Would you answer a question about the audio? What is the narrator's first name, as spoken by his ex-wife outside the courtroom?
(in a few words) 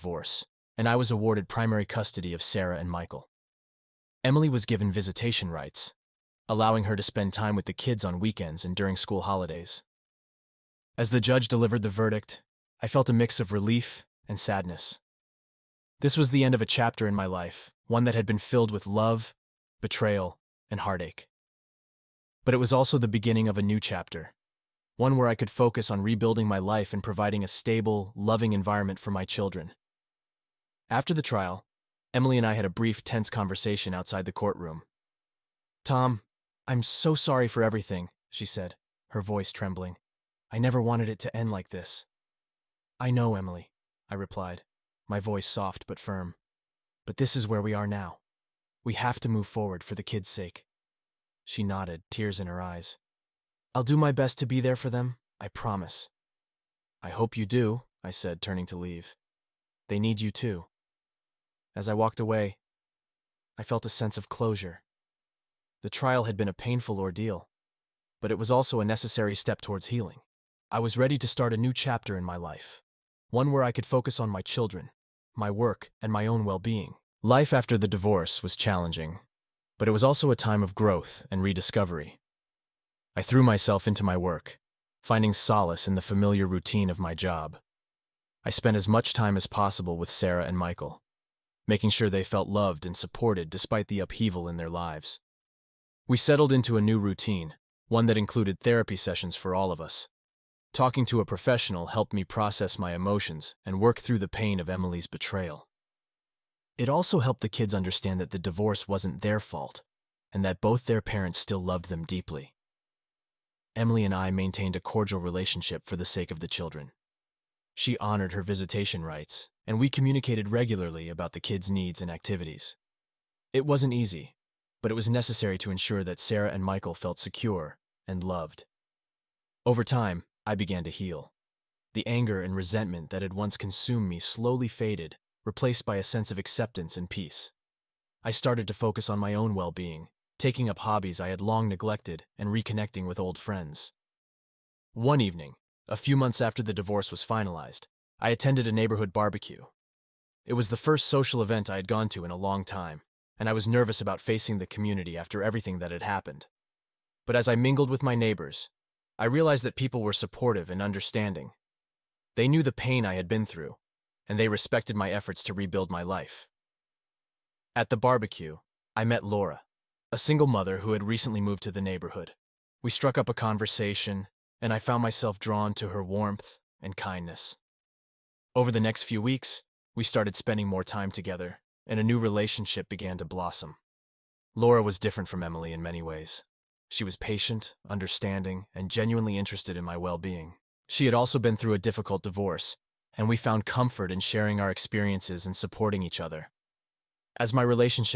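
Tom.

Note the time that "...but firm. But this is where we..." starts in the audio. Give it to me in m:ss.
0:45.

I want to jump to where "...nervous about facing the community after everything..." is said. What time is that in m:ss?
2:33.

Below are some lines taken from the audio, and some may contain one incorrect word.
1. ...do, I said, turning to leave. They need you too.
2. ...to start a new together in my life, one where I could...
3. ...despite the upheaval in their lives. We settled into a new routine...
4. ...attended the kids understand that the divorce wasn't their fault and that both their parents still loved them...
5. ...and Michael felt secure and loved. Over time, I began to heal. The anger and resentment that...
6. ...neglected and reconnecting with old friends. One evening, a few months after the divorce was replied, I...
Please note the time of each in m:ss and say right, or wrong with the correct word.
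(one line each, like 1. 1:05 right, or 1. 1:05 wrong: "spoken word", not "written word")
1. 0:57 right
2. 1:11 wrong: "chapter", not "together"
3. 1:33 right
4. 1:47 wrong: "helped", not "attended"
5. 2:06 right
6. 2:21 wrong: "finalized", not "replied".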